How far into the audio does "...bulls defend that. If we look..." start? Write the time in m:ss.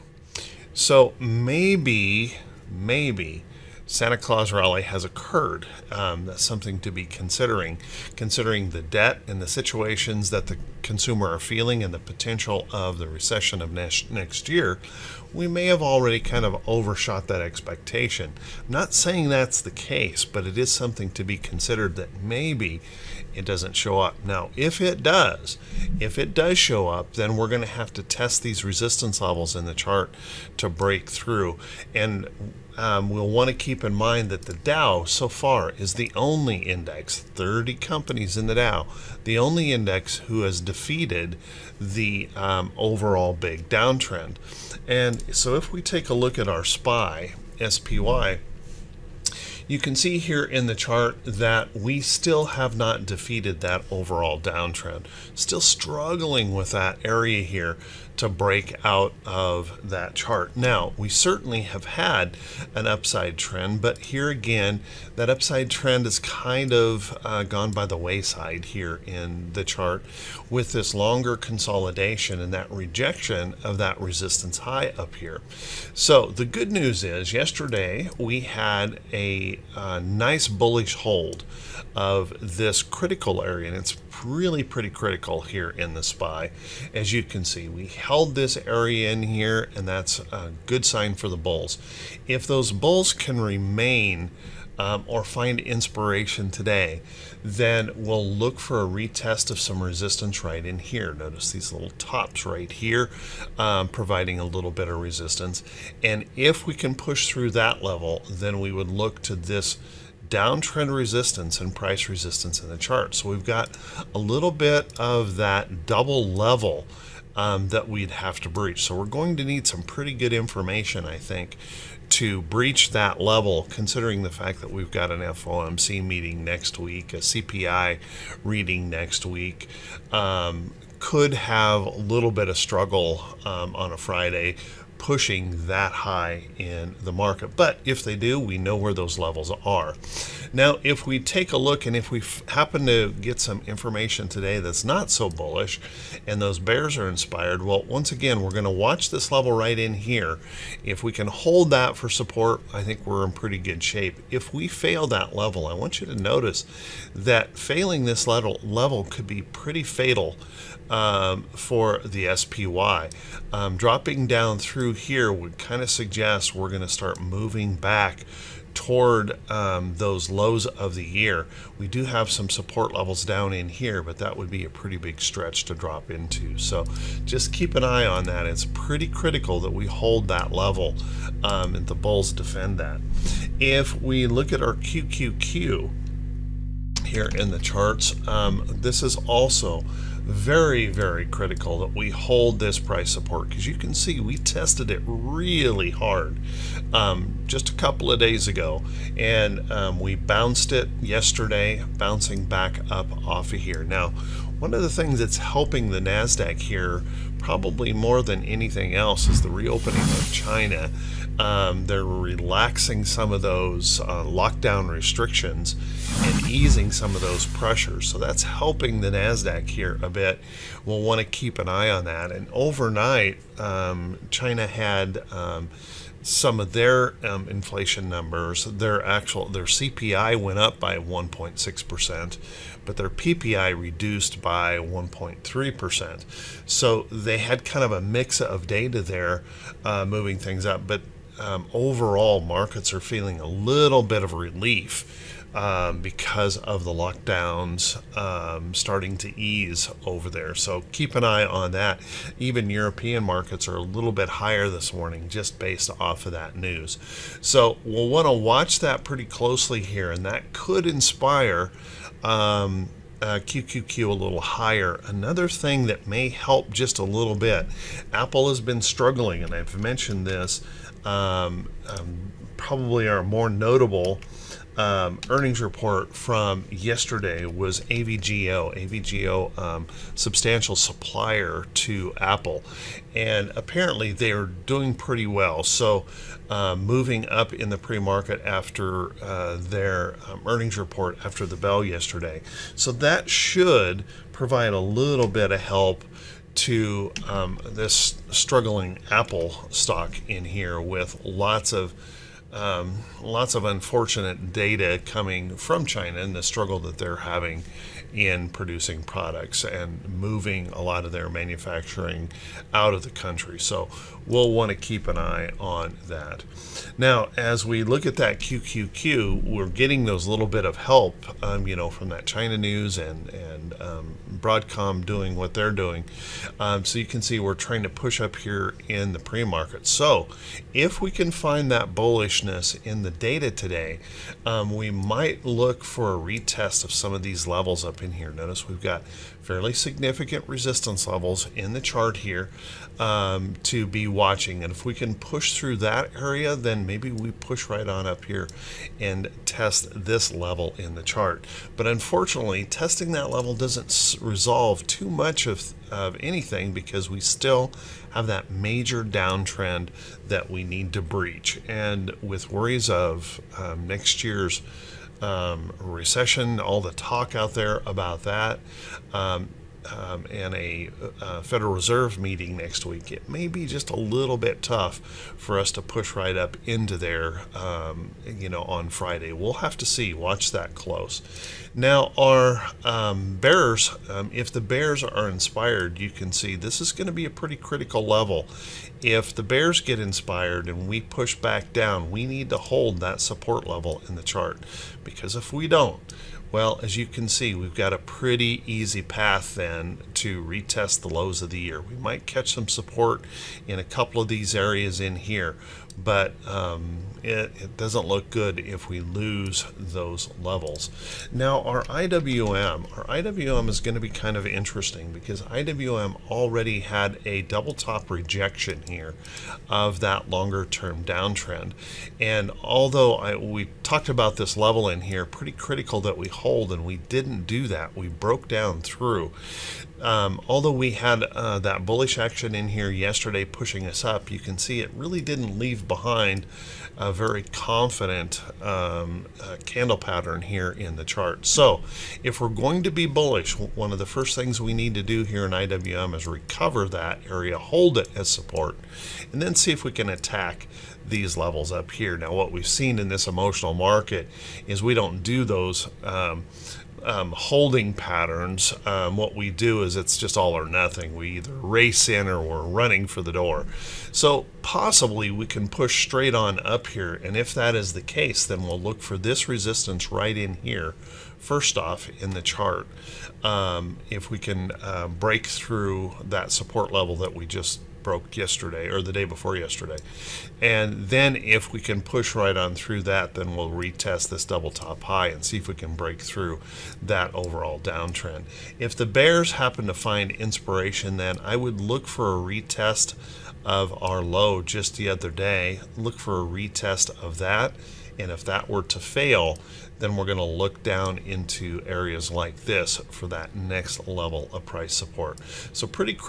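3:01.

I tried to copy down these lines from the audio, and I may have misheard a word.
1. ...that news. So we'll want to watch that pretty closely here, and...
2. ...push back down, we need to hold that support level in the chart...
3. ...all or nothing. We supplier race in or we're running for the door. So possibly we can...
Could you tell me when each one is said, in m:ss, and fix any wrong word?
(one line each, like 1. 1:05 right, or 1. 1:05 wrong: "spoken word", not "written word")
1. 4:16 right
2. 6:31 right
3. 7:40 wrong: "either", not "supplier".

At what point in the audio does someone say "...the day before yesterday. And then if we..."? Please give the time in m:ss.
7:59.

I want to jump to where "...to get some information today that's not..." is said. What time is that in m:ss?
2:22.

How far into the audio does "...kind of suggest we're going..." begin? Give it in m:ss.
2:45.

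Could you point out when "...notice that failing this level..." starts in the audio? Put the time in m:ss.
2:36.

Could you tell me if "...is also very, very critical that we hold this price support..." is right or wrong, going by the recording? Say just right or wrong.
right.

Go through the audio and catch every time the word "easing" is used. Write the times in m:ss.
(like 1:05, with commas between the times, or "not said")
3:36.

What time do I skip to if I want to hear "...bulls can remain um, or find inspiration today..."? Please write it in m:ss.
1:32.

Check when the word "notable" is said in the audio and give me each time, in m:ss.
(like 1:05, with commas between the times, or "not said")
4:33.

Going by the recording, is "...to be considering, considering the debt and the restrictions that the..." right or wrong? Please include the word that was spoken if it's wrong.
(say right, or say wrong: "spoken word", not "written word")
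wrong: "situations", not "restrictions".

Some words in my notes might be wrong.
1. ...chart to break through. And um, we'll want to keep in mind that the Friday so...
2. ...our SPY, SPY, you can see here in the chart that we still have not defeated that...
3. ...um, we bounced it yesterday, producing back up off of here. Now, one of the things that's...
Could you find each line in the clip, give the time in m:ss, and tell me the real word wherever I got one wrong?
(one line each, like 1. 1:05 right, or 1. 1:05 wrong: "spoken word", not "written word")
1. 0:29 wrong: "Dow", not "Friday"
2. 0:46 right
3. 3:19 wrong: "bouncing", not "producing".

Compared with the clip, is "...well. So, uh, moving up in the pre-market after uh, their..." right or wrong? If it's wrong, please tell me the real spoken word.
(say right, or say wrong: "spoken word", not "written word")
right.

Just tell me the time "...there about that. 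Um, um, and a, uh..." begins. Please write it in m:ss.
6:07.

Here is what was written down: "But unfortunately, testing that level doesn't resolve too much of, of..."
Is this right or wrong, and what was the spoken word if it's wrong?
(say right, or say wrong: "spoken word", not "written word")
right.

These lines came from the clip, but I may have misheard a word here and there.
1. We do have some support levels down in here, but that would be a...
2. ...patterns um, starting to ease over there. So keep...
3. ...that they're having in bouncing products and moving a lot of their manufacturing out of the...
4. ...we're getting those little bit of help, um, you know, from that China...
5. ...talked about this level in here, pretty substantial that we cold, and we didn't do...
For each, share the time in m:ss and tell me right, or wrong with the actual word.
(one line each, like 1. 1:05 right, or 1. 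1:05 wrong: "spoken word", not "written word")
1. 2:51 right
2. 4:06 wrong: "lockdowns", not "patterns"
3. 5:06 wrong: "producing", not "bouncing"
4. 5:19 right
5. 7:03 wrong: "critical", not "substantial".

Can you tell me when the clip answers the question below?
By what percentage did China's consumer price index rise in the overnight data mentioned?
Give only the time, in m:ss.
3:50.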